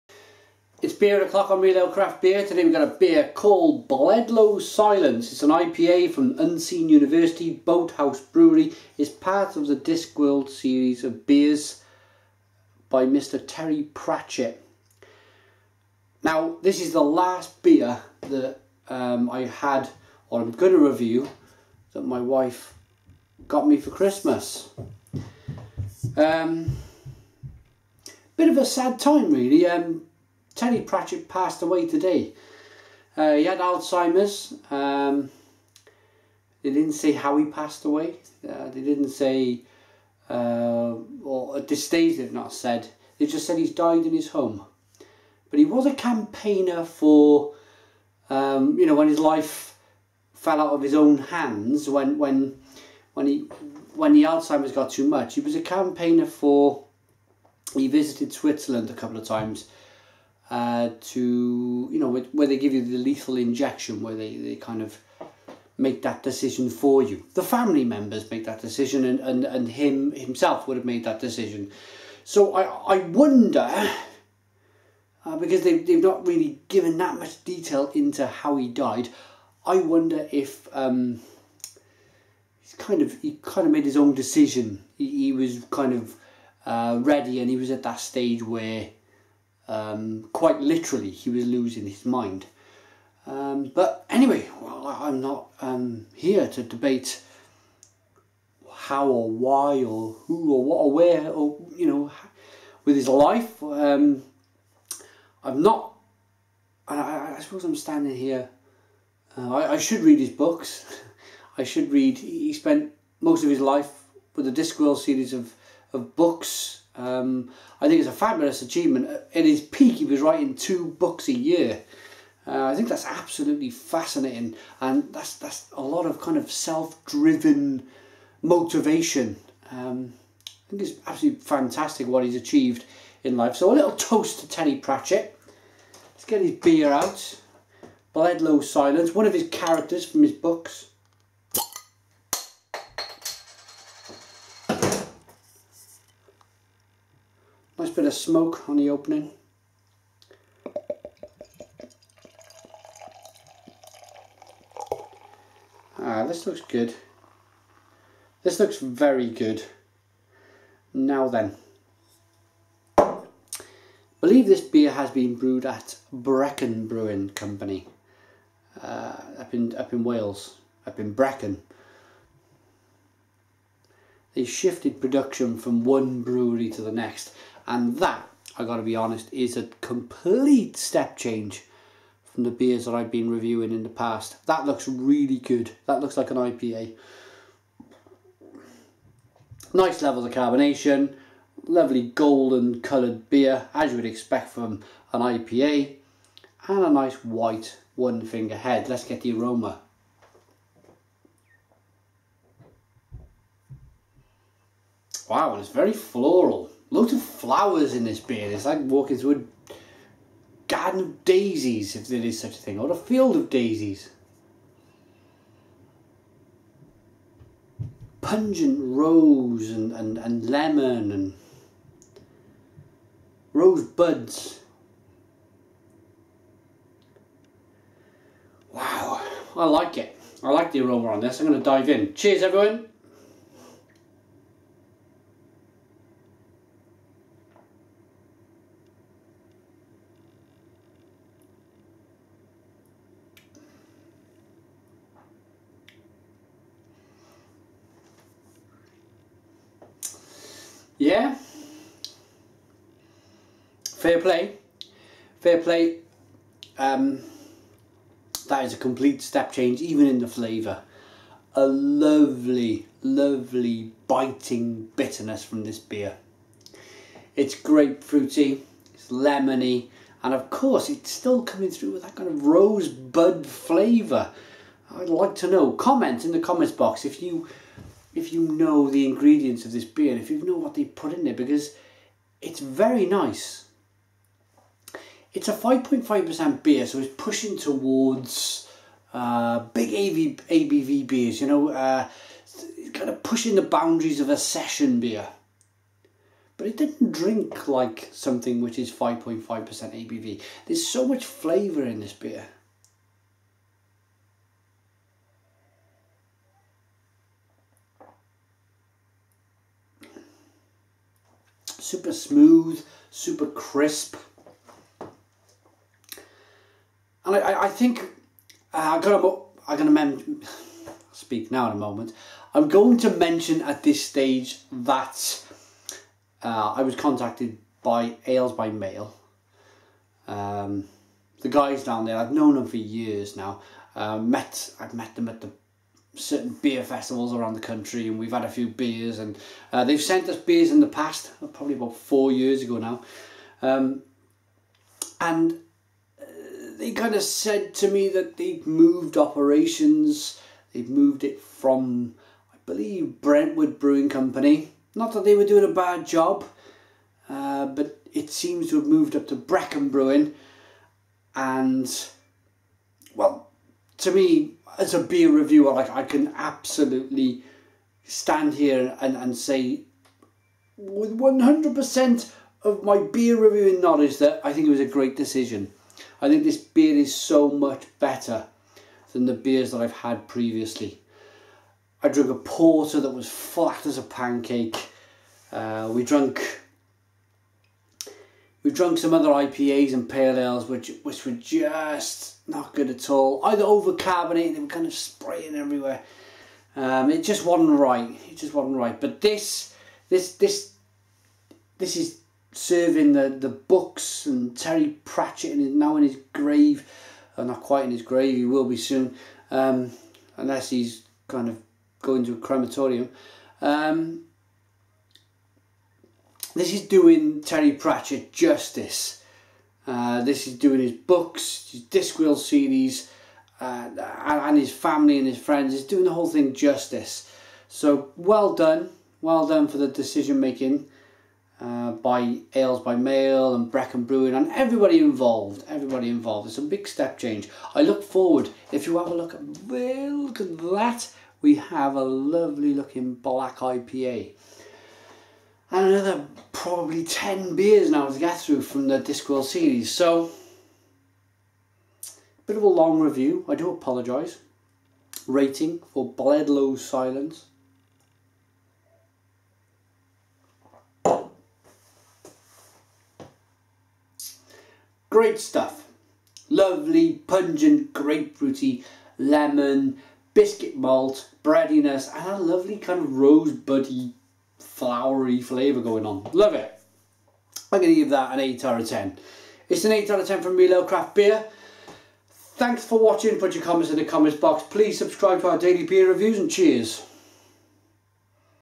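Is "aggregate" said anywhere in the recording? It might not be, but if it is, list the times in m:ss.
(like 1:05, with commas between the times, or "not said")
not said.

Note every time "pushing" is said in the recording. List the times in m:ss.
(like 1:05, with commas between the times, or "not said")
4:47, 4:53.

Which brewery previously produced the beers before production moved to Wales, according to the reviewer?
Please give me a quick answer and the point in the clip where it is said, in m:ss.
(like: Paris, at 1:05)
Brentwood Brewing Company, at 5:53.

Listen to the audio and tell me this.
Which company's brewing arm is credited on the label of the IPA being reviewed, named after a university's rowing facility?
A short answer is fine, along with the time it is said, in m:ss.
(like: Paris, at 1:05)
Unseen University Boathouse Brewery, at 0:06.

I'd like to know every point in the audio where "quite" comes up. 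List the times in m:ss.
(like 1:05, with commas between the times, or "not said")
1:30, 6:47.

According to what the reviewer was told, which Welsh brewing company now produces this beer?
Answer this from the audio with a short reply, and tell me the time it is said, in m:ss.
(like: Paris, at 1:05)
Brecon Brewing Company, at 2:46.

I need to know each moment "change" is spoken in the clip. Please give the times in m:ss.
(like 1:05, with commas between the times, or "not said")
3:01, 4:19, 7:17.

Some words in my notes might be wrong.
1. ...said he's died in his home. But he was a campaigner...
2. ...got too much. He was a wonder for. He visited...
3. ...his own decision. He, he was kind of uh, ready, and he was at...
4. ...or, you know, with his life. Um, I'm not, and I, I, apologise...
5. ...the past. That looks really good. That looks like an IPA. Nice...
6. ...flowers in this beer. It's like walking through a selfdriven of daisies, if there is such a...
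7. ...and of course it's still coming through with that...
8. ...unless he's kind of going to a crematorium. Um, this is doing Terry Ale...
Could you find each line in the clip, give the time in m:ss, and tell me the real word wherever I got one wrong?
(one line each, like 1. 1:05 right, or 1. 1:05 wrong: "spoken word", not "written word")
1. 0:43 right
2. 0:54 wrong: "campaigner", not "wonder"
3. 1:23 right
4. 1:41 wrong: "suppose", not "apologise"
5. 3:03 right
6. 3:27 wrong: "garden", not "selfdriven"
7. 4:30 right
8. 6:50 wrong: "Pratchett", not "Ale".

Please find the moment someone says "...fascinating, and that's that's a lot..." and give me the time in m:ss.
2:03.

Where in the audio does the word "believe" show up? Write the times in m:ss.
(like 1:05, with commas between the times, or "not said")
2:44, 5:52.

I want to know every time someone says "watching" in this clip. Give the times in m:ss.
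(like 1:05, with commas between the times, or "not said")
8:02.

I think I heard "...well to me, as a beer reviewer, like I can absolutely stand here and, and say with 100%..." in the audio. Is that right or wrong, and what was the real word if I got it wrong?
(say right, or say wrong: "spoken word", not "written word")
right.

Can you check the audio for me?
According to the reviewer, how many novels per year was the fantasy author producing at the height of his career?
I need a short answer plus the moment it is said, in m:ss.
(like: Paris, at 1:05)
2, at 2:00.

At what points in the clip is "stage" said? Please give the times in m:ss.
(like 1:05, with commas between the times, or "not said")
0:41, 1:28, 5:24.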